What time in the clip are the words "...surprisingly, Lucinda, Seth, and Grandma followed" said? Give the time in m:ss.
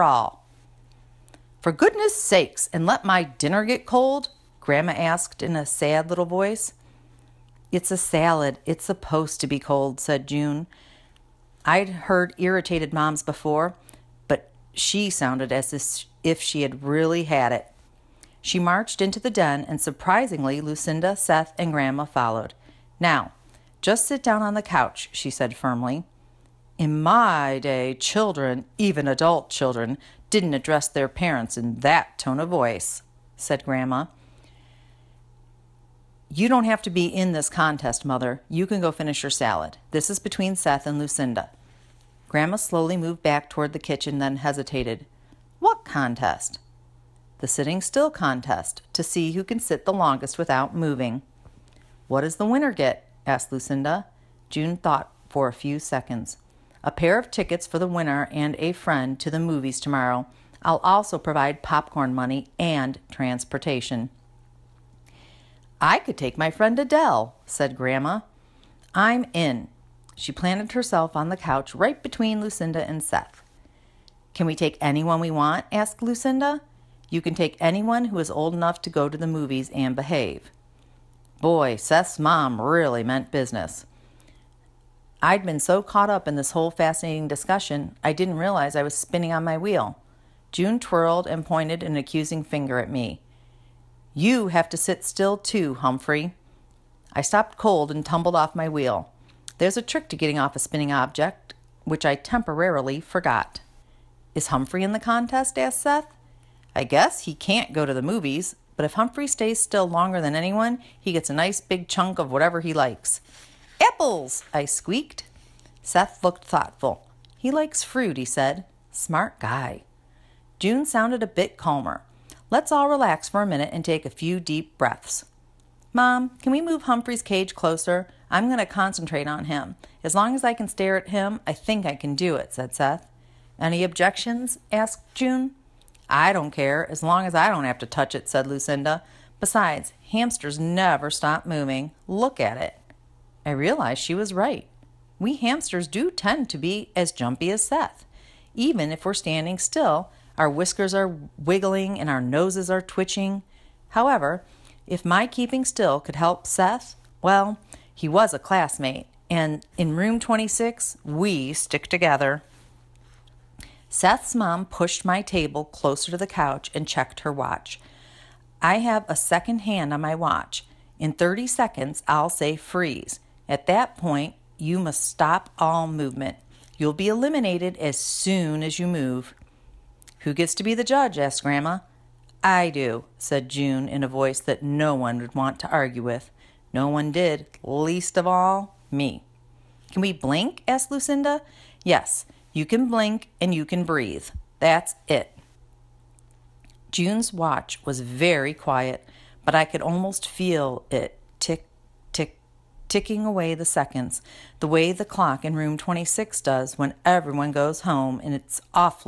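0:19.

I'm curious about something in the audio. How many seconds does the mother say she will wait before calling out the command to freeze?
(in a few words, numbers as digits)
30.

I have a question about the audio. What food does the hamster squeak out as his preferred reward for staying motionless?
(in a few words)
Apples.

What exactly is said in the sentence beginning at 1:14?
Can we take anyone we want?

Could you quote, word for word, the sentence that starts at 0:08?
It's supposed to be cold, said June.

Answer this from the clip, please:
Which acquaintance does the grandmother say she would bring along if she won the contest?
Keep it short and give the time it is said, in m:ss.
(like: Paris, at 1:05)
Adele, at 1:06.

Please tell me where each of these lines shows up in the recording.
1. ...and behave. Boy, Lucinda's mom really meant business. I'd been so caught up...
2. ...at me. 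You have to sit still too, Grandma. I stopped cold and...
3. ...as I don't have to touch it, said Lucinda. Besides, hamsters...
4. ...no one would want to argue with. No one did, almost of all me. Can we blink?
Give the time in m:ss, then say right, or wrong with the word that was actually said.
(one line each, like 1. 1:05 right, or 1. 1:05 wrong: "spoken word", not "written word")
1. 1:19 wrong: "Seth", not "Lucinda"
2. 1:32 wrong: "Humphrey", not "Grandma"
3. 2:17 right
4. 3:04 wrong: "least", not "almost".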